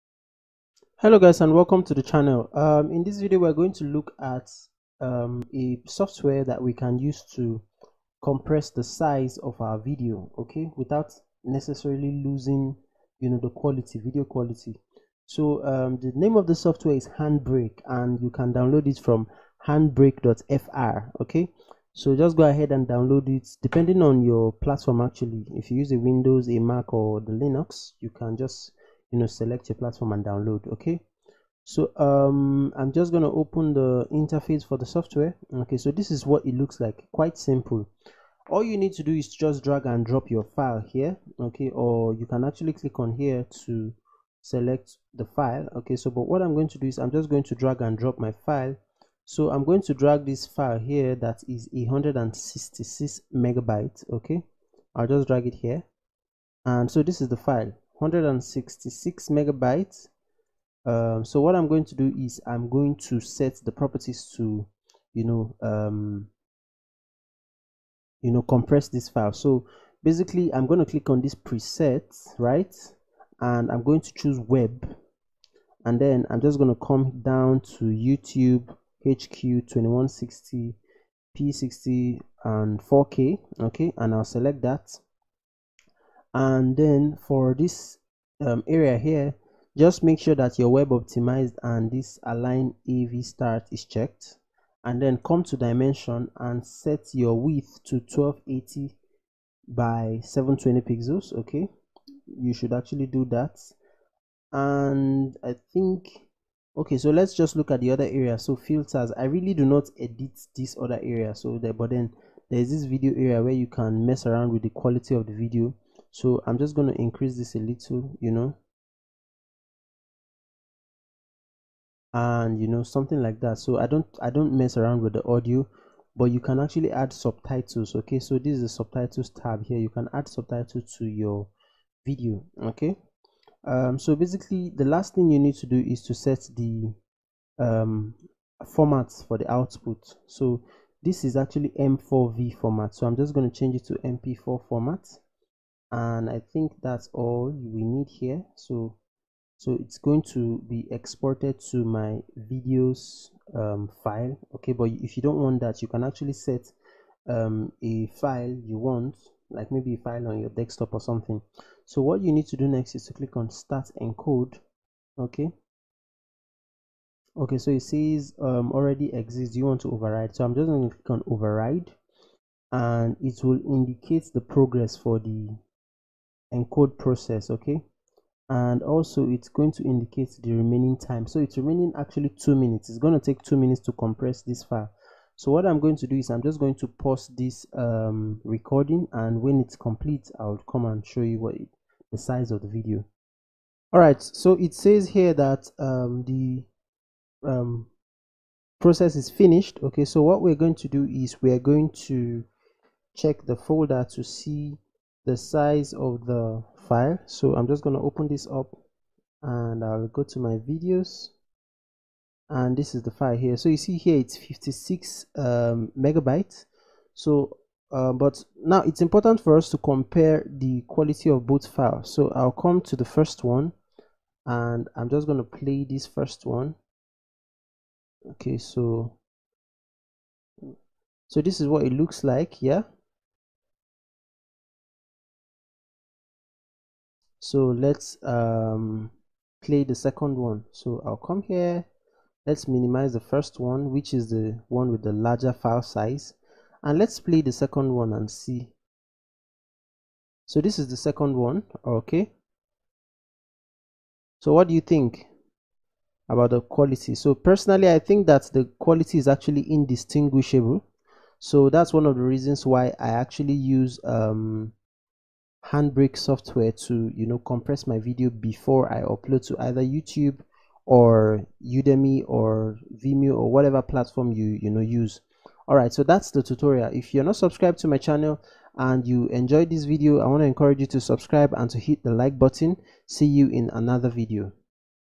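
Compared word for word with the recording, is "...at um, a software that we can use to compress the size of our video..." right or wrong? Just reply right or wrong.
right.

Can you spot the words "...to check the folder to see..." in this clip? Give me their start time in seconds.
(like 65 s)
201 s.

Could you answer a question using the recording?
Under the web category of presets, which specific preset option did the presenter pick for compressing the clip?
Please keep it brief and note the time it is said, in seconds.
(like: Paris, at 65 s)
YouTube HQ 2160 P60, at 77 s.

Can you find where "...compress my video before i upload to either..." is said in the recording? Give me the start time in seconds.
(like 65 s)
267 s.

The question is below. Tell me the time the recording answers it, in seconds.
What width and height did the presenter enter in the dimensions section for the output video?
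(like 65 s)
97 s.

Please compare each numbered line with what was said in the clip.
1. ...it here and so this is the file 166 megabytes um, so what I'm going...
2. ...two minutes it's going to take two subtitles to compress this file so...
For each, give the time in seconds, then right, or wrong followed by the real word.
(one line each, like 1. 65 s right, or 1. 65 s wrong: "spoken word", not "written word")
1. 55 s right
2. 182 s wrong: "minutes", not "subtitles".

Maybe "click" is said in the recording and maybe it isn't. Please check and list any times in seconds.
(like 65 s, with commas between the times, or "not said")
42 s, 70 s, 163 s, 170 s.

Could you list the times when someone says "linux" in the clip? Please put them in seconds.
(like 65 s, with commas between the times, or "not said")
27 s.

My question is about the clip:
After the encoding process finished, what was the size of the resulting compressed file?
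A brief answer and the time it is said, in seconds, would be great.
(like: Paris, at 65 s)
56 megabytes, at 214 s.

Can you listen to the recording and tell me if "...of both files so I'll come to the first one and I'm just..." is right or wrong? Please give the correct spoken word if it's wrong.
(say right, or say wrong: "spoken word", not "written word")
right.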